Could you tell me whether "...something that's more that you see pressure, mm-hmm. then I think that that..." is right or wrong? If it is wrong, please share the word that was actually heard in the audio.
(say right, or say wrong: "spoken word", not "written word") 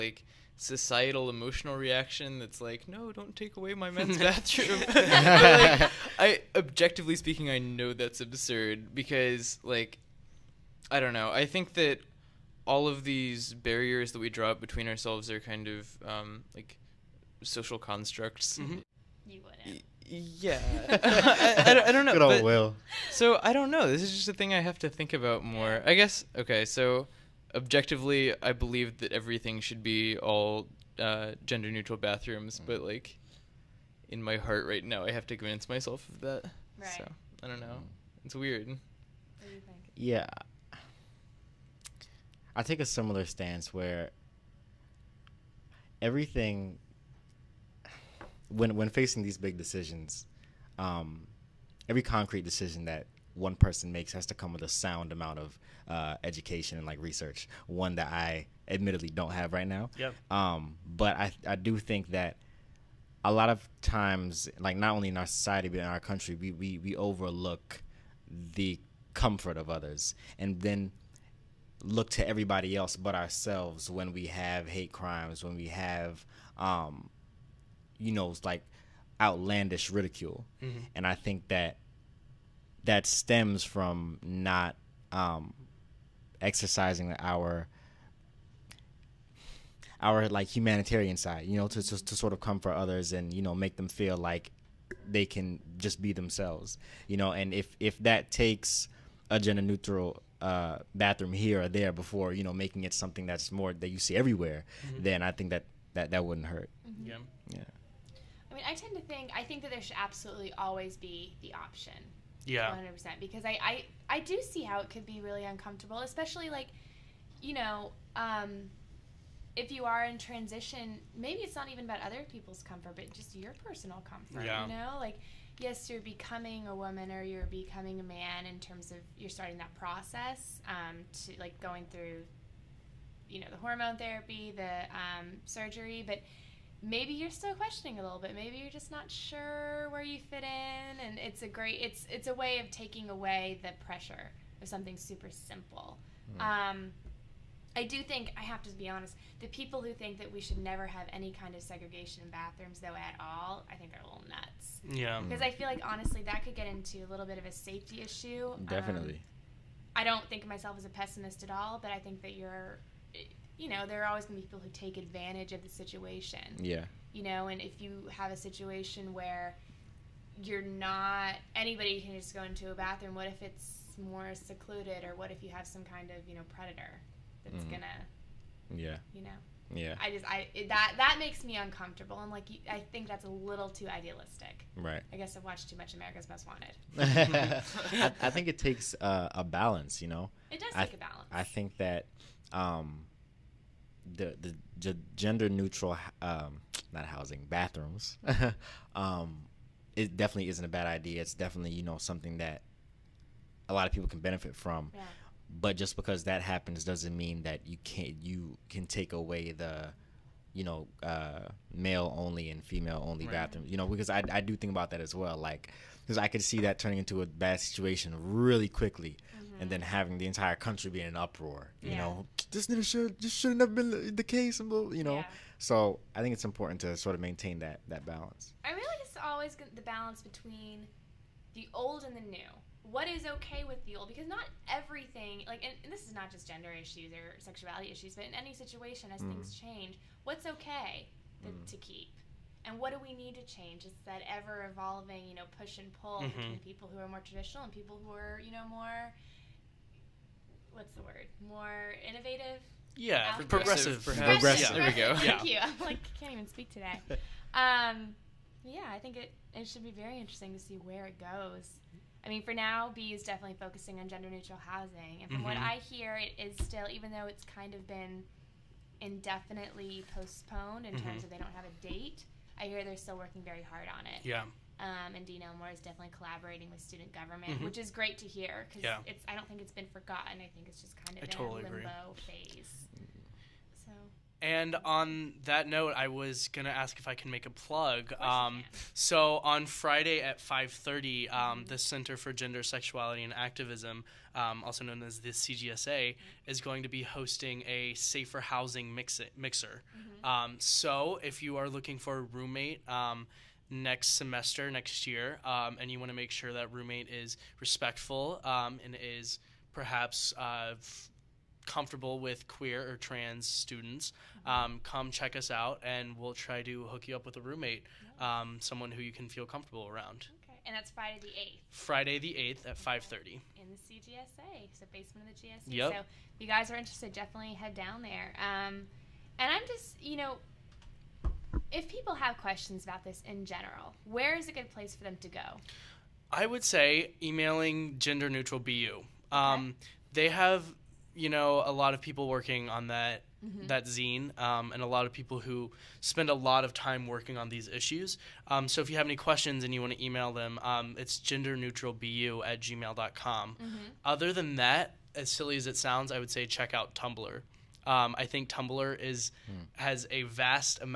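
wrong: "everywhere", not "pressure".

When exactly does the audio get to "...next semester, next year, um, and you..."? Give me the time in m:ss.
5:03.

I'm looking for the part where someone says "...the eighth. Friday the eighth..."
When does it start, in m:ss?
5:21.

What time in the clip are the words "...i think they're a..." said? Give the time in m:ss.
2:33.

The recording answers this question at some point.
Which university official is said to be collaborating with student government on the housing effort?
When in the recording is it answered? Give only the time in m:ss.
4:35.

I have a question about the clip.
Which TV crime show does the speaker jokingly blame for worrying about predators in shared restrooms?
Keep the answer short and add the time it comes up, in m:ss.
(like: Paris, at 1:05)
America's Most Wanted, at 3:05.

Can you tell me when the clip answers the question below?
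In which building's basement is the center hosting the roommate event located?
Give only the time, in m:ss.
5:25.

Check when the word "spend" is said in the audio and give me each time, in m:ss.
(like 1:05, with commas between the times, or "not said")
5:46.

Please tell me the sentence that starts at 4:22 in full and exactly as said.
I mean, for now, B is definitely focusing on gender neutral housing, and from mm-hmm.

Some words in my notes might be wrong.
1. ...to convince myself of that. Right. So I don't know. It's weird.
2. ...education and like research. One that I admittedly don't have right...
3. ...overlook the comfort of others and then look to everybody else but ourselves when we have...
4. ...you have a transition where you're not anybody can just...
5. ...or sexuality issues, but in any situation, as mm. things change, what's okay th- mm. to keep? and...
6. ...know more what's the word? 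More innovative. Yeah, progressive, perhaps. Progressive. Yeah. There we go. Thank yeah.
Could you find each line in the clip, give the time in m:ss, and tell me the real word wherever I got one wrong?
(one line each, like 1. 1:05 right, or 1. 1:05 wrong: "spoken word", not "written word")
1. 0:35 right
2. 0:56 right
3. 1:06 right
4. 2:47 wrong: "situation", not "transition"
5. 3:57 right
6. 4:08 right.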